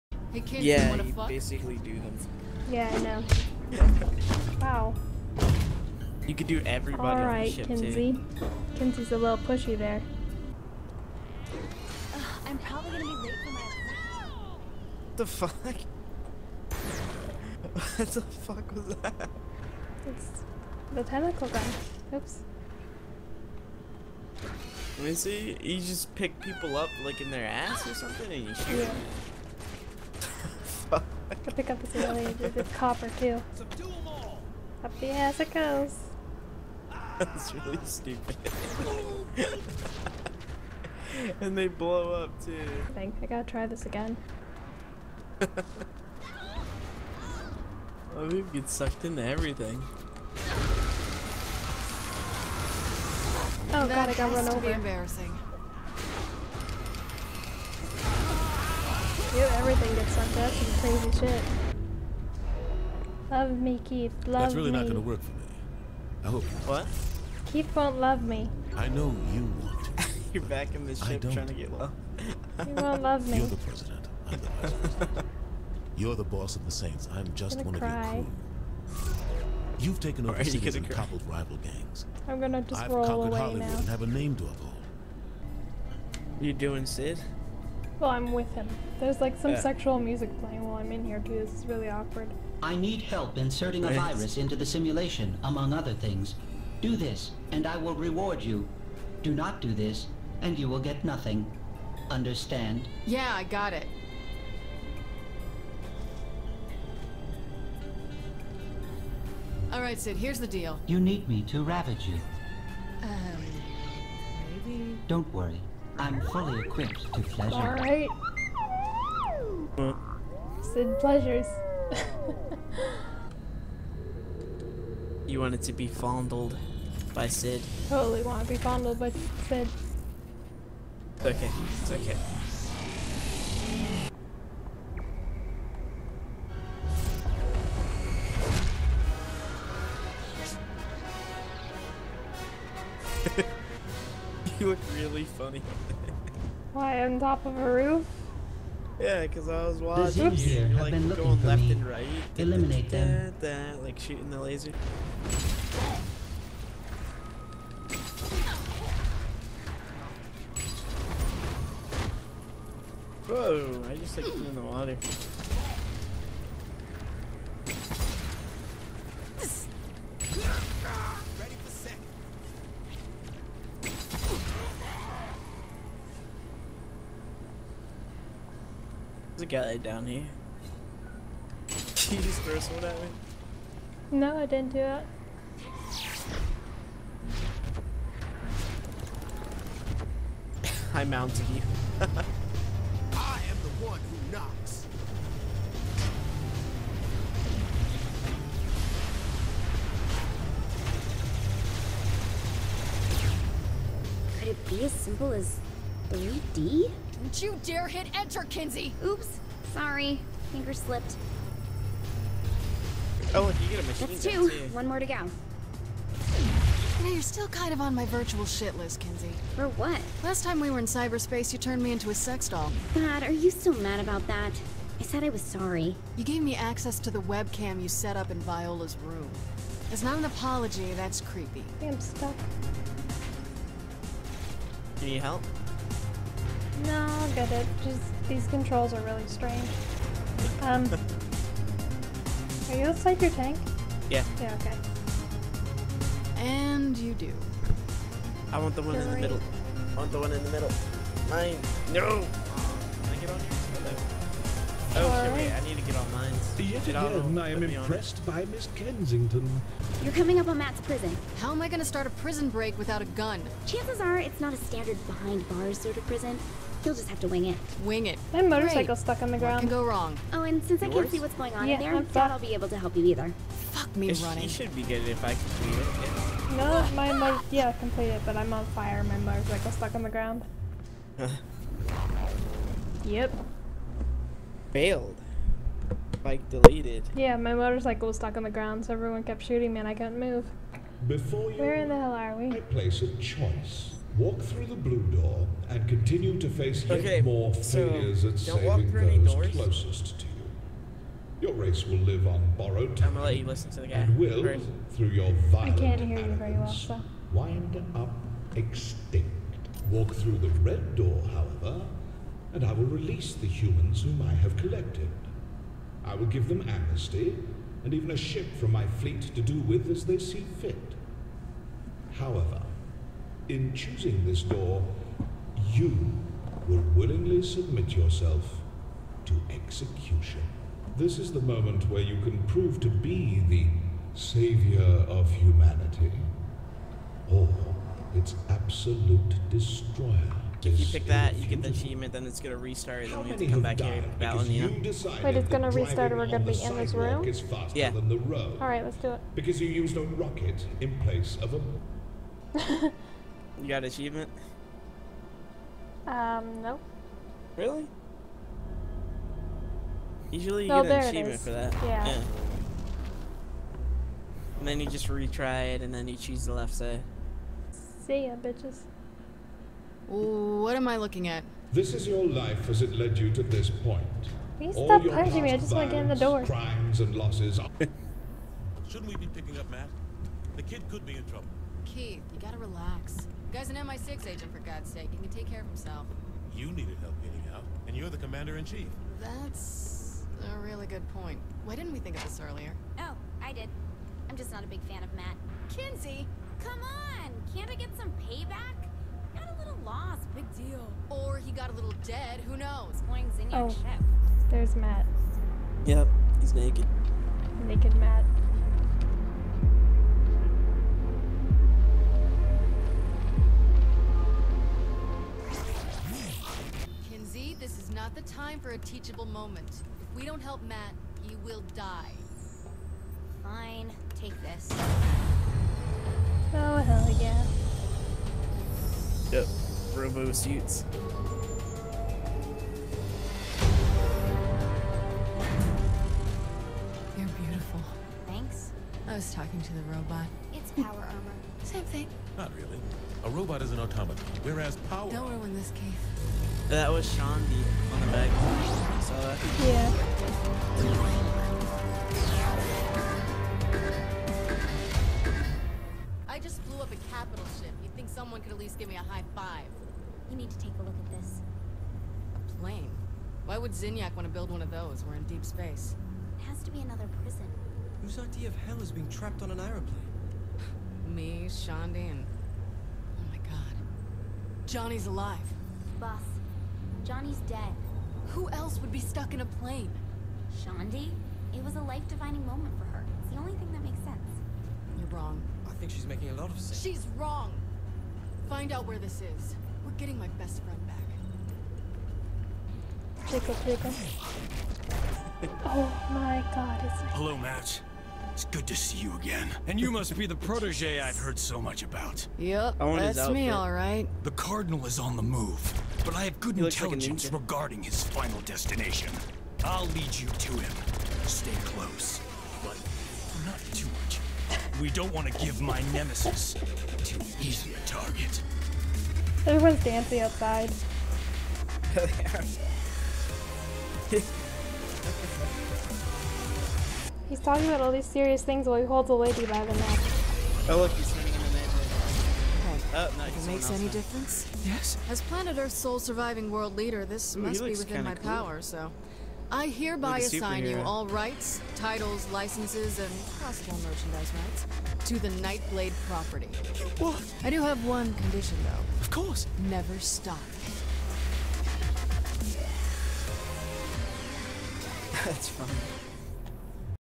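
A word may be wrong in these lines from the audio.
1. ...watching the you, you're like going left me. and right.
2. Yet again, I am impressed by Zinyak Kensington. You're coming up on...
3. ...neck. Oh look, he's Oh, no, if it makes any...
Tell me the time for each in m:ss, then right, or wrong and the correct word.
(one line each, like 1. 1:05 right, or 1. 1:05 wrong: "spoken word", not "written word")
1. 2:29 right
2. 4:16 wrong: "Miss", not "Zinyak"
3. 8:49 right.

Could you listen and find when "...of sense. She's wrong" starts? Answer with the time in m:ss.
8:06.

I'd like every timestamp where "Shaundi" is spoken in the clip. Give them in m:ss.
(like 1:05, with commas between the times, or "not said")
7:27, 7:51, 8:00.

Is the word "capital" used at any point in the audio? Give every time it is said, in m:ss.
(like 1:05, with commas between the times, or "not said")
7:37.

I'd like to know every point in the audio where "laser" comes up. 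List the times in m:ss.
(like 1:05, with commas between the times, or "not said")
2:34.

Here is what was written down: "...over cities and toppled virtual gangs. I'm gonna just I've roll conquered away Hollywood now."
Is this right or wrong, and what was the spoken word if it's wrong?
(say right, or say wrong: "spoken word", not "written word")
wrong: "rival", not "virtual".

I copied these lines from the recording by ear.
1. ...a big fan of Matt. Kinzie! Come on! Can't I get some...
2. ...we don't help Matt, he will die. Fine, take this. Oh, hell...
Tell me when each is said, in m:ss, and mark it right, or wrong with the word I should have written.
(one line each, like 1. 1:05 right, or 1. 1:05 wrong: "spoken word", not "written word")
1. 6:34 right
2. 7:00 right.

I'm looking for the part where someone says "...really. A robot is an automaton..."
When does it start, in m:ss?
7:22.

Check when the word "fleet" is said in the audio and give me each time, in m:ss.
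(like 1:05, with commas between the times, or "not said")
5:18.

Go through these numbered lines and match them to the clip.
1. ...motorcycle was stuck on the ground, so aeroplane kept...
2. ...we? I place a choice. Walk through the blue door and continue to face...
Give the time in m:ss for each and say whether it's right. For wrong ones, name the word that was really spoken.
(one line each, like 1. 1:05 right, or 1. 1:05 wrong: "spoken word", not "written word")
1. 4:47 wrong: "everyone", not "aeroplane"
2. 4:52 right.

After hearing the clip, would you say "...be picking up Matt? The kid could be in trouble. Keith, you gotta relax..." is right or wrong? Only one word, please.
right.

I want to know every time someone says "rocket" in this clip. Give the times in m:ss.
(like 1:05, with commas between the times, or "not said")
5:50.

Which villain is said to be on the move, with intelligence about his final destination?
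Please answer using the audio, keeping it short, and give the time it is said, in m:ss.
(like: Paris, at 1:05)
The Cardinal, at 8:24.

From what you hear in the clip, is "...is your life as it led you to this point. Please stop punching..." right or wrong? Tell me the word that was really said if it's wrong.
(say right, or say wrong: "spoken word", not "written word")
right.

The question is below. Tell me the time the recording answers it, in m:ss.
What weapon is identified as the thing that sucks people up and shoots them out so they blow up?
0:21.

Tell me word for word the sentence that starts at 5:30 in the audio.
This is the moment where you can prove to be the savior of humanity, or its absolute destroyer.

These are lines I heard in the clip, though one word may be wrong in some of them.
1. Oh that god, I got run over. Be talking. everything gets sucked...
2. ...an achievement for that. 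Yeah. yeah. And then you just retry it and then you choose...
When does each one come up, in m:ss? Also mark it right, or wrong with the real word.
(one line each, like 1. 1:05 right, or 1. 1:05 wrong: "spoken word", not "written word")
1. 0:53 wrong: "embarrassing", not "talking"
2. 6:00 right.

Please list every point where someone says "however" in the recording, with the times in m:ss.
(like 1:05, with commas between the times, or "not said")
5:11, 5:22.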